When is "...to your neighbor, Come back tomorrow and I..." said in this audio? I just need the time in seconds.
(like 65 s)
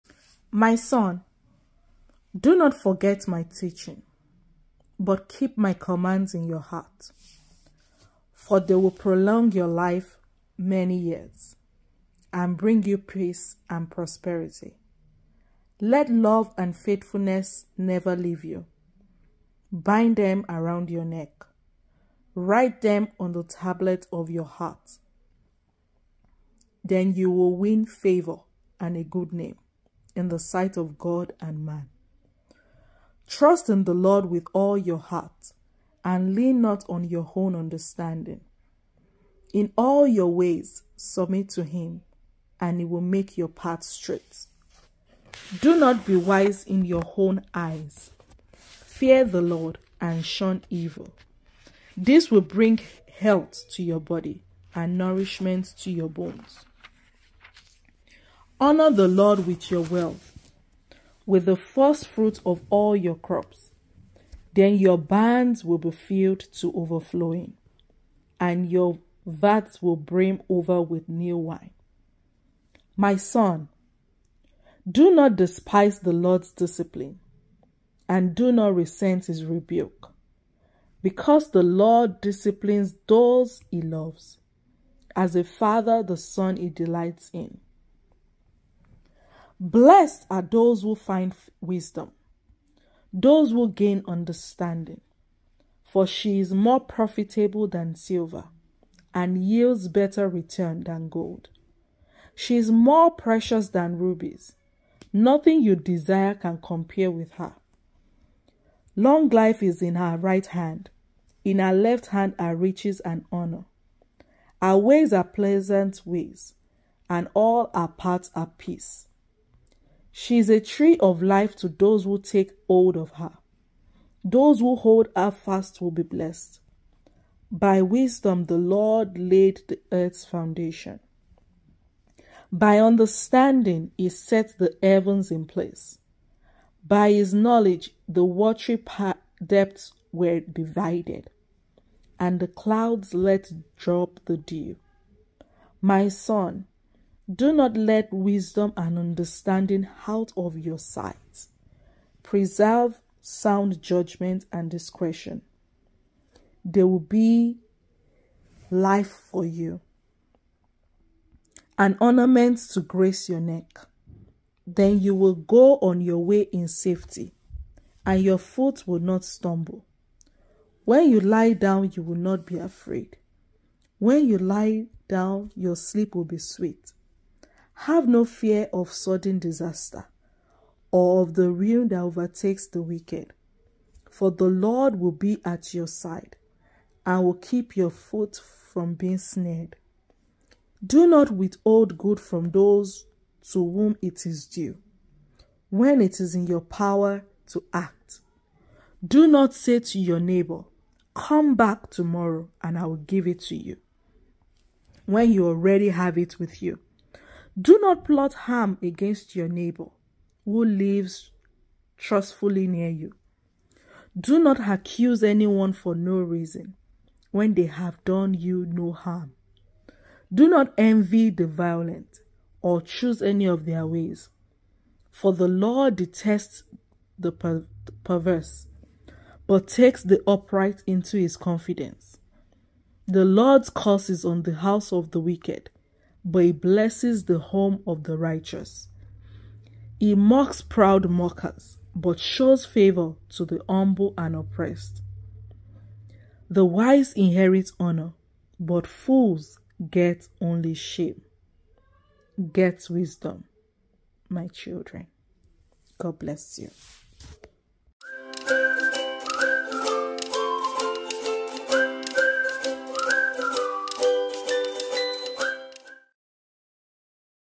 199 s.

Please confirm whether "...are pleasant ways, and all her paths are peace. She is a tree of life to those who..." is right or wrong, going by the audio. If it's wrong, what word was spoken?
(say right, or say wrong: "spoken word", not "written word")
right.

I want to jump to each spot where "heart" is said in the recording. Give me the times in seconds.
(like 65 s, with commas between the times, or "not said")
6 s, 24 s, 34 s.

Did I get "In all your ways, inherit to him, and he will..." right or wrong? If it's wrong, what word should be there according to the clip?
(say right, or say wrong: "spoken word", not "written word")
wrong: "submit", not "inherit".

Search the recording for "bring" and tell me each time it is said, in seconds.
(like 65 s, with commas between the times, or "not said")
12 s, 52 s.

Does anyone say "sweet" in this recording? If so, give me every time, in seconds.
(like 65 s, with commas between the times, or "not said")
176 s.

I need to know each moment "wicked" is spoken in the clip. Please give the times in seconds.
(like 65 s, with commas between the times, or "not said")
182 s, 235 s.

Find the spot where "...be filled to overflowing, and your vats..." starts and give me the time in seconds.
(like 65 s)
65 s.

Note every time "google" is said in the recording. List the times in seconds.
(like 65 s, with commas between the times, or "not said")
not said.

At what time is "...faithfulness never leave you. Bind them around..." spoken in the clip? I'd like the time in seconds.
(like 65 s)
16 s.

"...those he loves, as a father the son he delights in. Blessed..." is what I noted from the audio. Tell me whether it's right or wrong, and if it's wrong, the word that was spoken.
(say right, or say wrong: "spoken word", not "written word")
right.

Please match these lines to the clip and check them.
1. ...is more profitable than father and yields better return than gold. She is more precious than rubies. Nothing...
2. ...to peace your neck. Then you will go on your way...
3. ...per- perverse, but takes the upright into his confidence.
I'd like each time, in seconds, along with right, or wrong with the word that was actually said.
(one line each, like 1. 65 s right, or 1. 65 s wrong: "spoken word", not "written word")
1. 96 s wrong: "silver", not "father"
2. 162 s wrong: "grace", not "peace"
3. 227 s right.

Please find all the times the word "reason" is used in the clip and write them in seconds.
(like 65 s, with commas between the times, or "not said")
216 s.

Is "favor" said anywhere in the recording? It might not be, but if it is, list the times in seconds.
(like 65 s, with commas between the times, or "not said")
27 s, 242 s.